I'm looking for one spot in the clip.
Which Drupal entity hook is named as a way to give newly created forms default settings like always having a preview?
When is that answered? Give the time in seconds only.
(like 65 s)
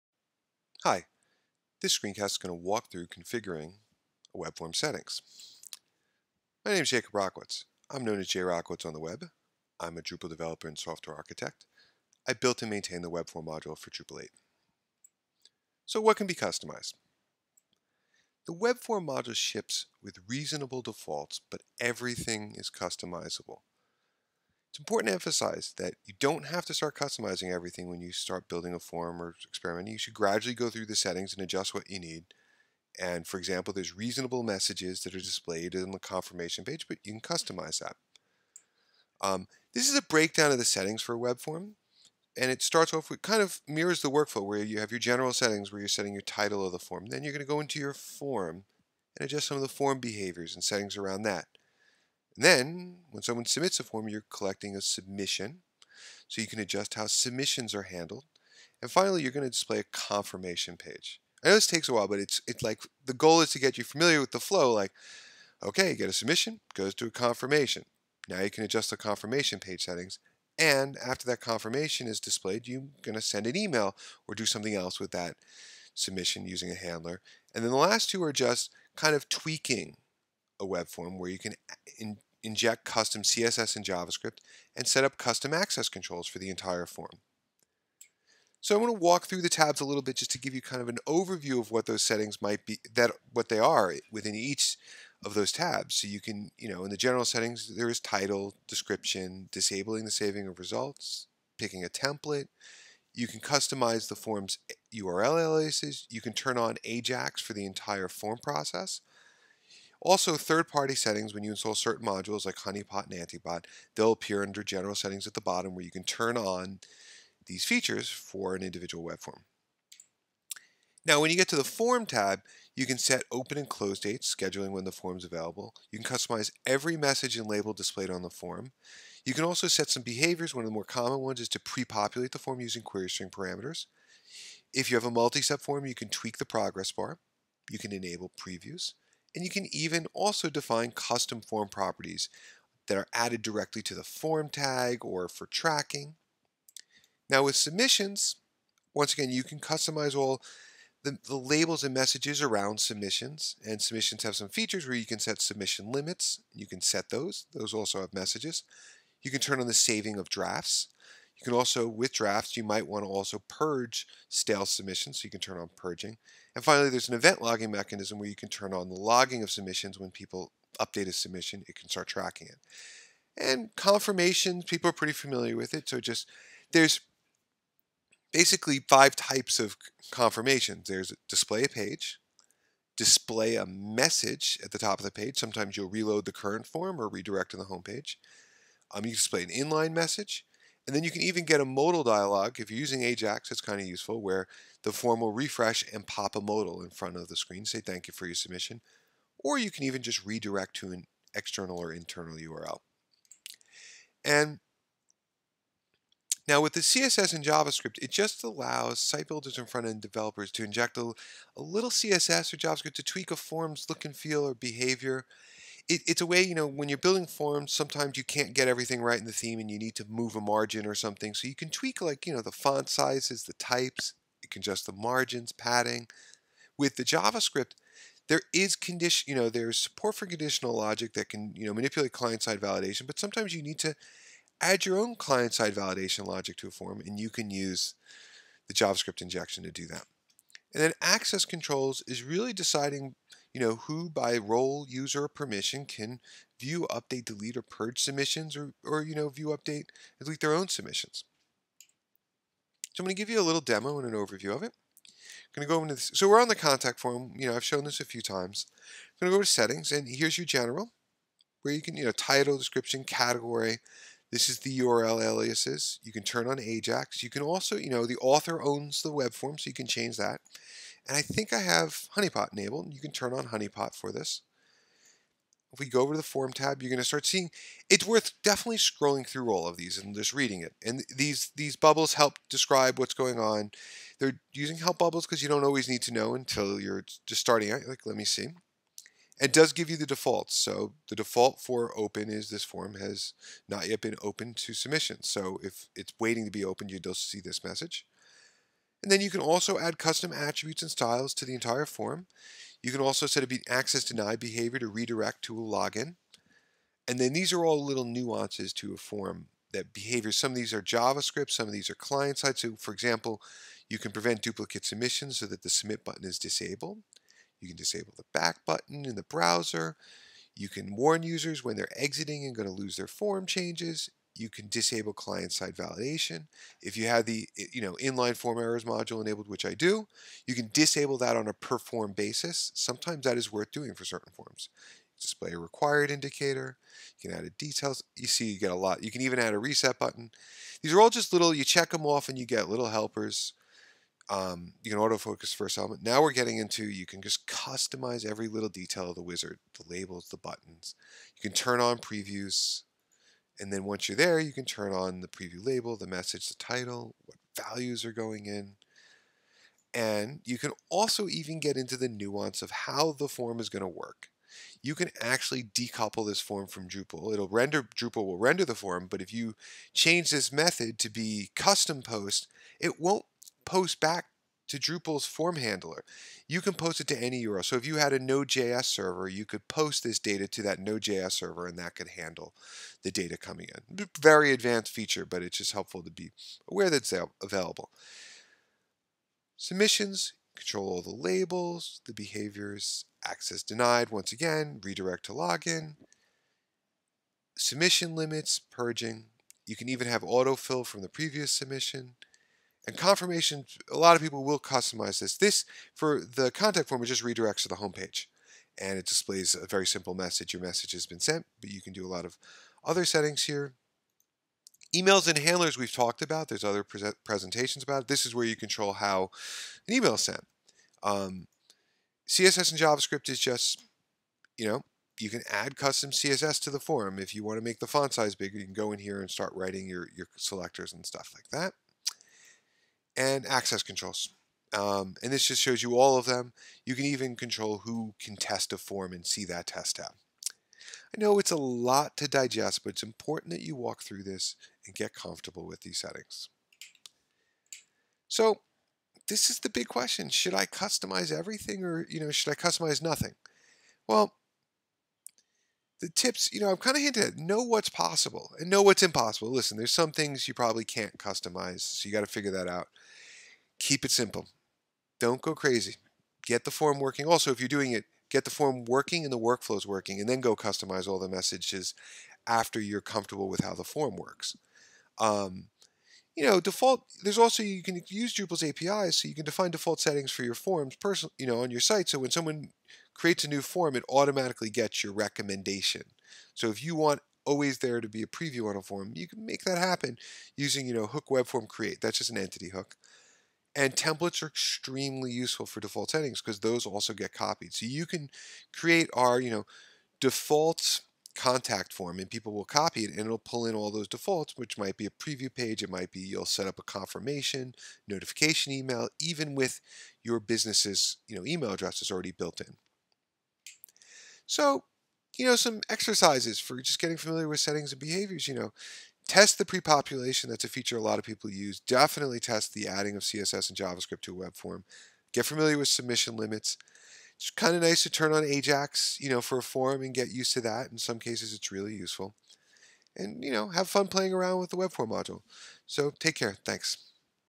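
491 s.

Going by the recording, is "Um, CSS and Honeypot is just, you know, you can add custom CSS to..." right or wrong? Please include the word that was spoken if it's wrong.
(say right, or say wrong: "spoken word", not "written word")
wrong: "JavaScript", not "Honeypot".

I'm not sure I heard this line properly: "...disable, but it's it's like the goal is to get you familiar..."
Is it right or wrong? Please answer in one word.
wrong.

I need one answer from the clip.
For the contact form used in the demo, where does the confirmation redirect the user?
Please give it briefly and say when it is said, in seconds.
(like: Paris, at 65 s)
The homepage, at 407 s.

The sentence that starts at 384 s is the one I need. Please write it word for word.
Very advanced feature, but it's just helpful to be aware that it's available.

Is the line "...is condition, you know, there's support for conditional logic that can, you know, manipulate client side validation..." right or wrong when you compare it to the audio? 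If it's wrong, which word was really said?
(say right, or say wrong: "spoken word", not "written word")
right.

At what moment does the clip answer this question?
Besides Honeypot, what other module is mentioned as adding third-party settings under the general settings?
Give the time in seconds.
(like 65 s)
113 s.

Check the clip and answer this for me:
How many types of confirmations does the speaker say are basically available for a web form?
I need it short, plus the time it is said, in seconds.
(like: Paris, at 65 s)
5, at 178 s.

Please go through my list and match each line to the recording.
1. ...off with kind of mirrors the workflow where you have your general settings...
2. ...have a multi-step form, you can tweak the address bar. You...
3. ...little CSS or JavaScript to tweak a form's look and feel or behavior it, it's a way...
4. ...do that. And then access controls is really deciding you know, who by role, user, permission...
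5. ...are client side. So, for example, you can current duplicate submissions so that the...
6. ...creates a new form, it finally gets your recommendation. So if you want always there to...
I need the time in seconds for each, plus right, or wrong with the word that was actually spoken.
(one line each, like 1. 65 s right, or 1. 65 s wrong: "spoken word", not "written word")
1. 42 s right
2. 134 s wrong: "progress", not "address"
3. 211 s right
4. 239 s right
5. 311 s wrong: "prevent", not "current"
6. 483 s wrong: "automatically", not "finally".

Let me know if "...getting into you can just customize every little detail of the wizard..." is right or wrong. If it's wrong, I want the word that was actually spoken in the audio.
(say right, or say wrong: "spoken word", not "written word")
right.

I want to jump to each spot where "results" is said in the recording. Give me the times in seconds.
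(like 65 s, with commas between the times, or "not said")
100 s.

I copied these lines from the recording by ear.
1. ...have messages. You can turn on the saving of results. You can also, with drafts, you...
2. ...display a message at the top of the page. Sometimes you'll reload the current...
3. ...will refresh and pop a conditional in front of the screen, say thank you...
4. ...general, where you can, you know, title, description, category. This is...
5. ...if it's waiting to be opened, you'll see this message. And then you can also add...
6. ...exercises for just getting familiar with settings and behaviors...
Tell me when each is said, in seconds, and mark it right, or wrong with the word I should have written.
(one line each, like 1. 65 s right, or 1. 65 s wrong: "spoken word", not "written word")
1. 158 s wrong: "drafts", not "results"
2. 182 s right
3. 195 s wrong: "modal", not "conditional"
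4. 260 s right
5. 295 s right
6. 515 s right.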